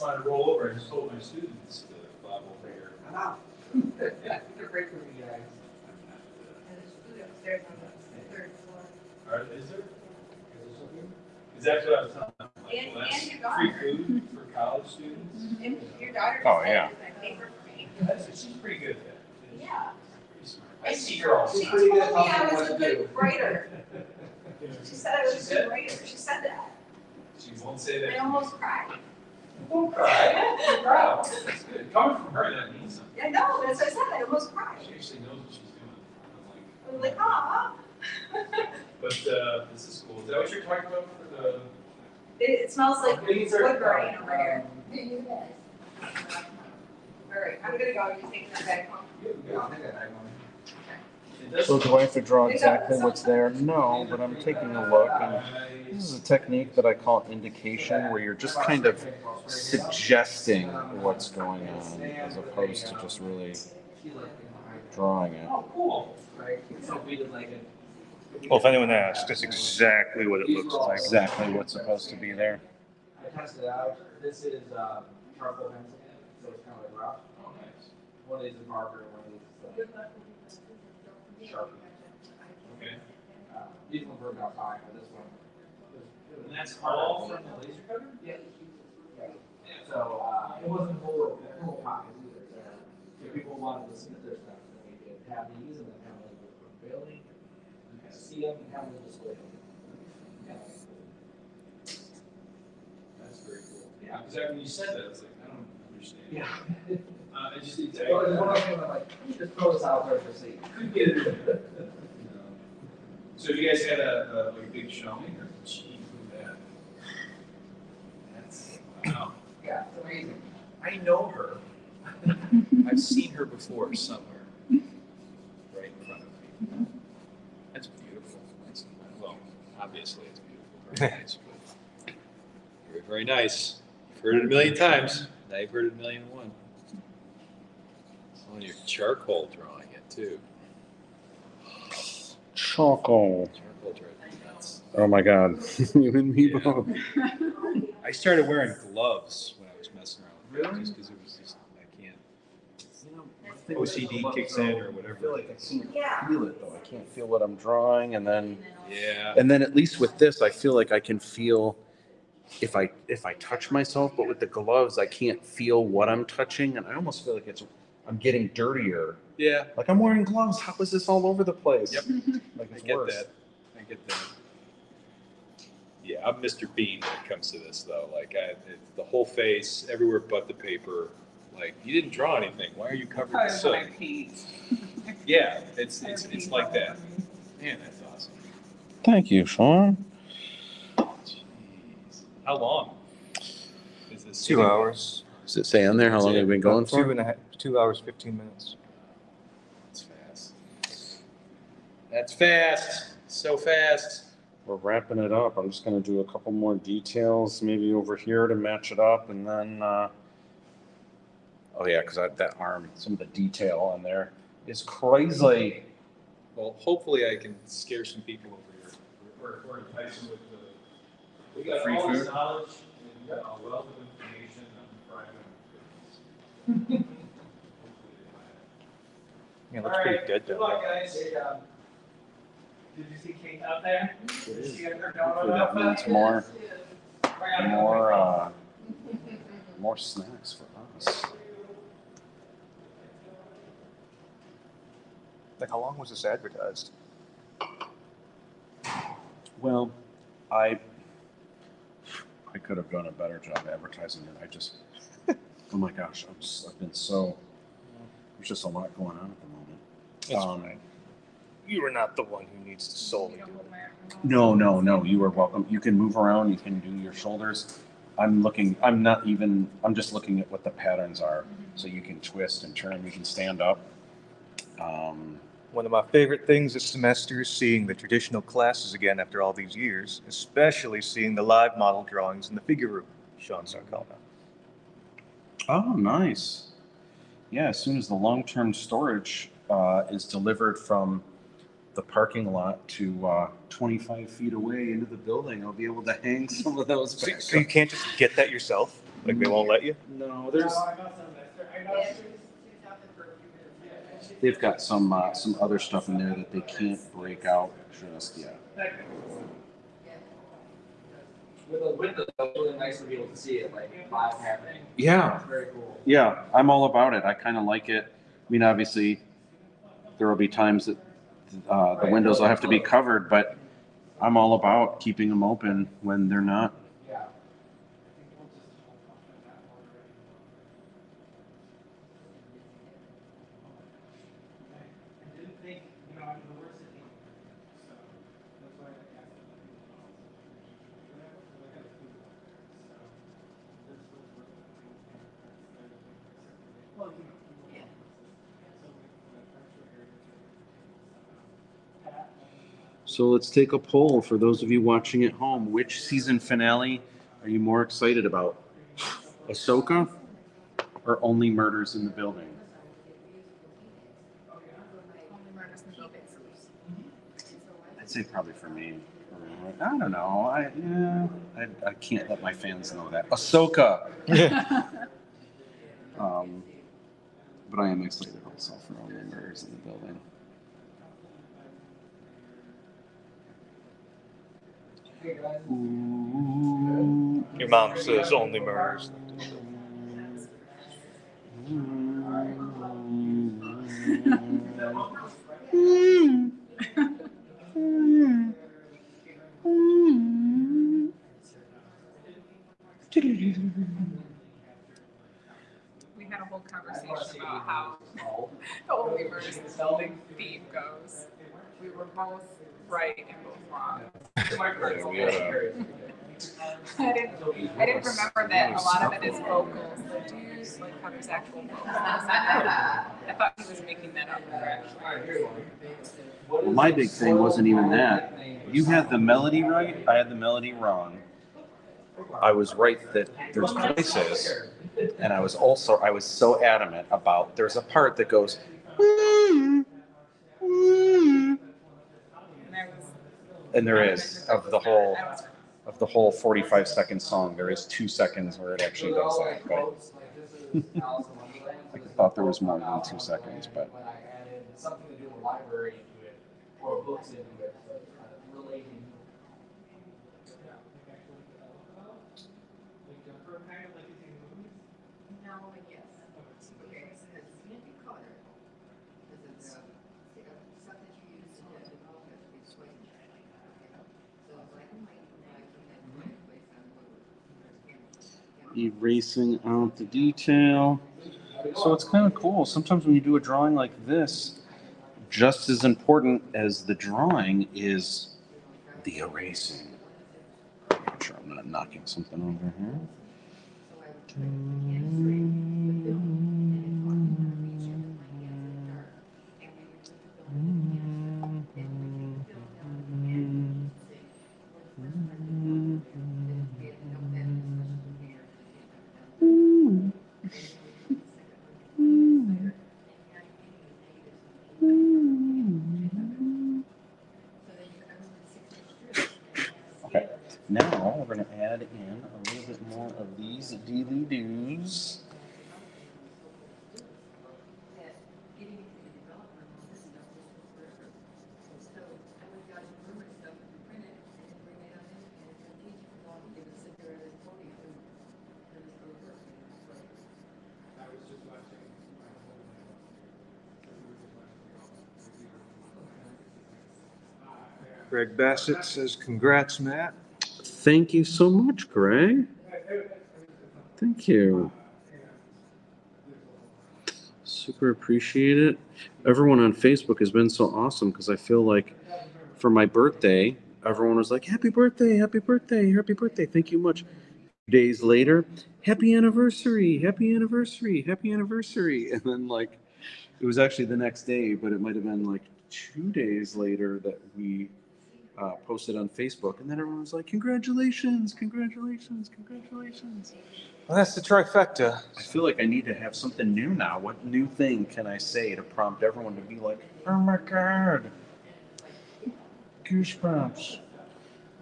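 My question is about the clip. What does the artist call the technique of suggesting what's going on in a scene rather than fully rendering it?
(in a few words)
indication.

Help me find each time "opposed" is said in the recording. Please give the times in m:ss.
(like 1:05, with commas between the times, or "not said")
1:02.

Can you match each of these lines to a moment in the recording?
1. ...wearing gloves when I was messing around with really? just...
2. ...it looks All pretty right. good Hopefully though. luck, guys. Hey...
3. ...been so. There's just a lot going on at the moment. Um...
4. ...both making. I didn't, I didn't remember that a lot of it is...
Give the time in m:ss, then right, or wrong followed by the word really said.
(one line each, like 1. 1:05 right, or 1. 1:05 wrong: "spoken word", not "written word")
1. 2:28 right
2. 3:49 wrong: "Good", not "Hopefully"
3. 4:16 right
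4. 6:53 wrong: "wrong", not "making".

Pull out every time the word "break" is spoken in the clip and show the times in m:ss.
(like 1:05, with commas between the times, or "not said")
0:04, 5:07.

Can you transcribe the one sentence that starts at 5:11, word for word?
With a window, really nice to be able to see it like happening.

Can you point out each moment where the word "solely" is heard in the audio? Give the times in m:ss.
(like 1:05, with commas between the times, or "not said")
4:22.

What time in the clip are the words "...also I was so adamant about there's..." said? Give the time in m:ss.
7:15.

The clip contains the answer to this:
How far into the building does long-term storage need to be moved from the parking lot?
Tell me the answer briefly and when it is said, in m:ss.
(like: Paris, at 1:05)
25 feet, at 4:53.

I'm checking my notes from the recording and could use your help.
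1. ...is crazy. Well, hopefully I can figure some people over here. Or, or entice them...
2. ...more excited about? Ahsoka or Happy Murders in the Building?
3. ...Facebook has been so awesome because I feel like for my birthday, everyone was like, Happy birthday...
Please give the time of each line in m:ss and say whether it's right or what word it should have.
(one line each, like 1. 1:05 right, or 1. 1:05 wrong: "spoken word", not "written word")
1. 3:34 wrong: "scare", not "figure"
2. 5:57 wrong: "Only", not "Happy"
3. 9:19 right.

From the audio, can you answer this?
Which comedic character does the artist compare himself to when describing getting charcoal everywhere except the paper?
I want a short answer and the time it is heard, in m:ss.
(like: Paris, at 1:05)
Mr. Bean, at 2:56.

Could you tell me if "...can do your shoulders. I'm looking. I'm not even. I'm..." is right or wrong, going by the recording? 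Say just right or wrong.
right.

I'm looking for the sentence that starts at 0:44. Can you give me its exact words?
Um, All right, I'm gonna go.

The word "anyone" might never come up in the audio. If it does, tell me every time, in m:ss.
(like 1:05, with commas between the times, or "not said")
1:08.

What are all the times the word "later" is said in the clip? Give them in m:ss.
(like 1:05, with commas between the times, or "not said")
9:28, 9:36.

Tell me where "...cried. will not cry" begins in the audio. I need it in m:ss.
0:28.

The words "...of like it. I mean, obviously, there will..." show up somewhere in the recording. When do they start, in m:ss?
5:17.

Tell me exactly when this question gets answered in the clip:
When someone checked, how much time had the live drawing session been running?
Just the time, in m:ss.
3:17.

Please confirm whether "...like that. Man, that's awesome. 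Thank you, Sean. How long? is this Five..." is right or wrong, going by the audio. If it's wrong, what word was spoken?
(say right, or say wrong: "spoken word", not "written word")
wrong: "Two", not "Five".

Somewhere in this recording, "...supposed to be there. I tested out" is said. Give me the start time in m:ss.
1:11.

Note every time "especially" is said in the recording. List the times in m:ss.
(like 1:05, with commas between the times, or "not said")
4:40.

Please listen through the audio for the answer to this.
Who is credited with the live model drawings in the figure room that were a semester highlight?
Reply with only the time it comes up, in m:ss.
4:43.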